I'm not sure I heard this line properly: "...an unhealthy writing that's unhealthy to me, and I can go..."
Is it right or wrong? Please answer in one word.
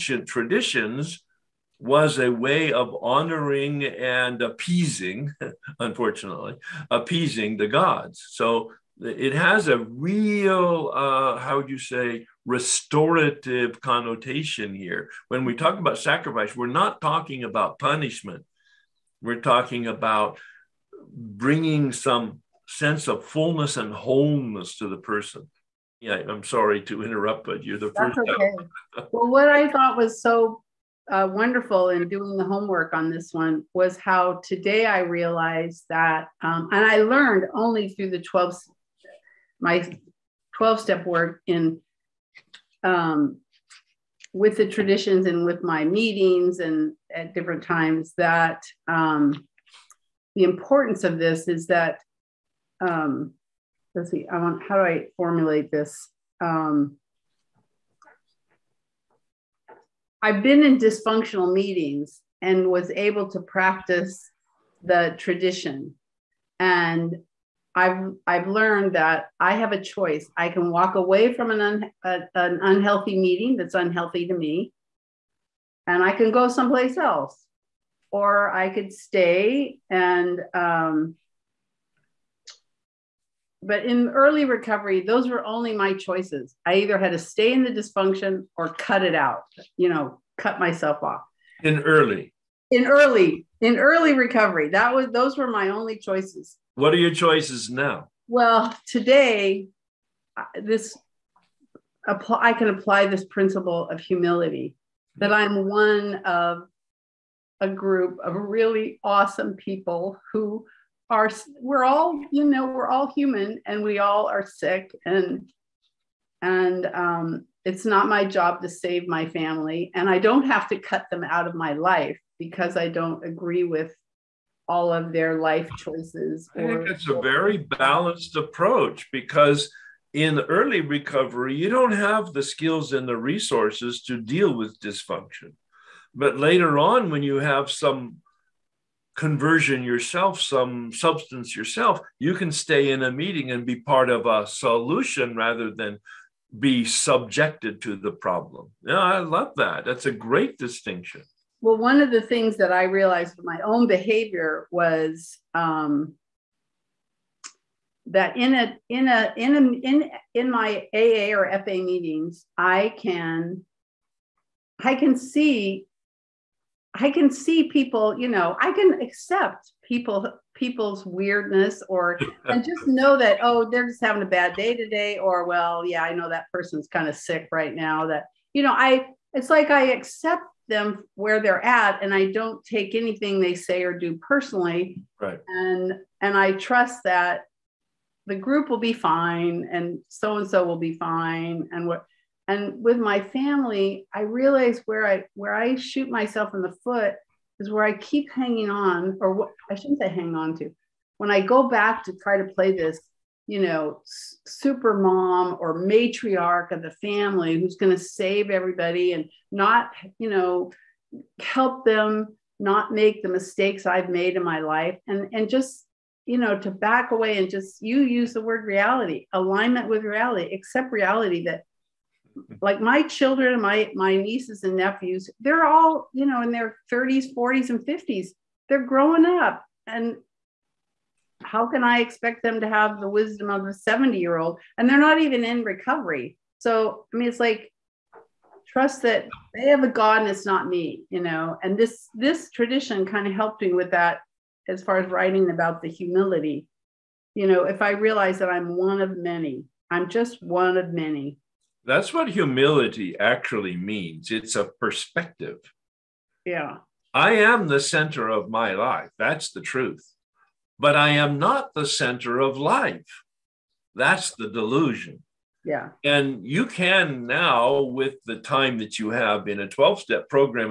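wrong.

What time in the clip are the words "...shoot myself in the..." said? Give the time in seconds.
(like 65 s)
195 s.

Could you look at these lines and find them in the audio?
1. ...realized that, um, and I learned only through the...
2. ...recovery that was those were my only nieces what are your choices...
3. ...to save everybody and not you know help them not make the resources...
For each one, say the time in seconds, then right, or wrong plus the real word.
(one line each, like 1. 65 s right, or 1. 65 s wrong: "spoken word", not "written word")
1. 35 s right
2. 94 s wrong: "choices", not "nieces"
3. 207 s wrong: "mistakes", not "resources".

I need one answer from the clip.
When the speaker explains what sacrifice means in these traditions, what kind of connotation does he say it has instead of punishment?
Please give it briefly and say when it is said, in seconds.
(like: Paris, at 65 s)
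Restorative, at 12 s.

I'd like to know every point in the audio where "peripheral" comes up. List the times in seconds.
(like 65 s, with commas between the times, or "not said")
not said.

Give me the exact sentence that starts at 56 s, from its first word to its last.
Um, I've been in dysfunctional meetings and was able to practice the tradition.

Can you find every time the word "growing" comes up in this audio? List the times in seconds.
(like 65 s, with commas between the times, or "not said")
228 s.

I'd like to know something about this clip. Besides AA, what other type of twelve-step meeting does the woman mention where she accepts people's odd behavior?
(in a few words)
FA.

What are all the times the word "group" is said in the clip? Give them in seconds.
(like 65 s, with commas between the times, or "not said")
107 s, 188 s.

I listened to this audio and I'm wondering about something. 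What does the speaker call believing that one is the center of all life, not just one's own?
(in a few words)
The delusion.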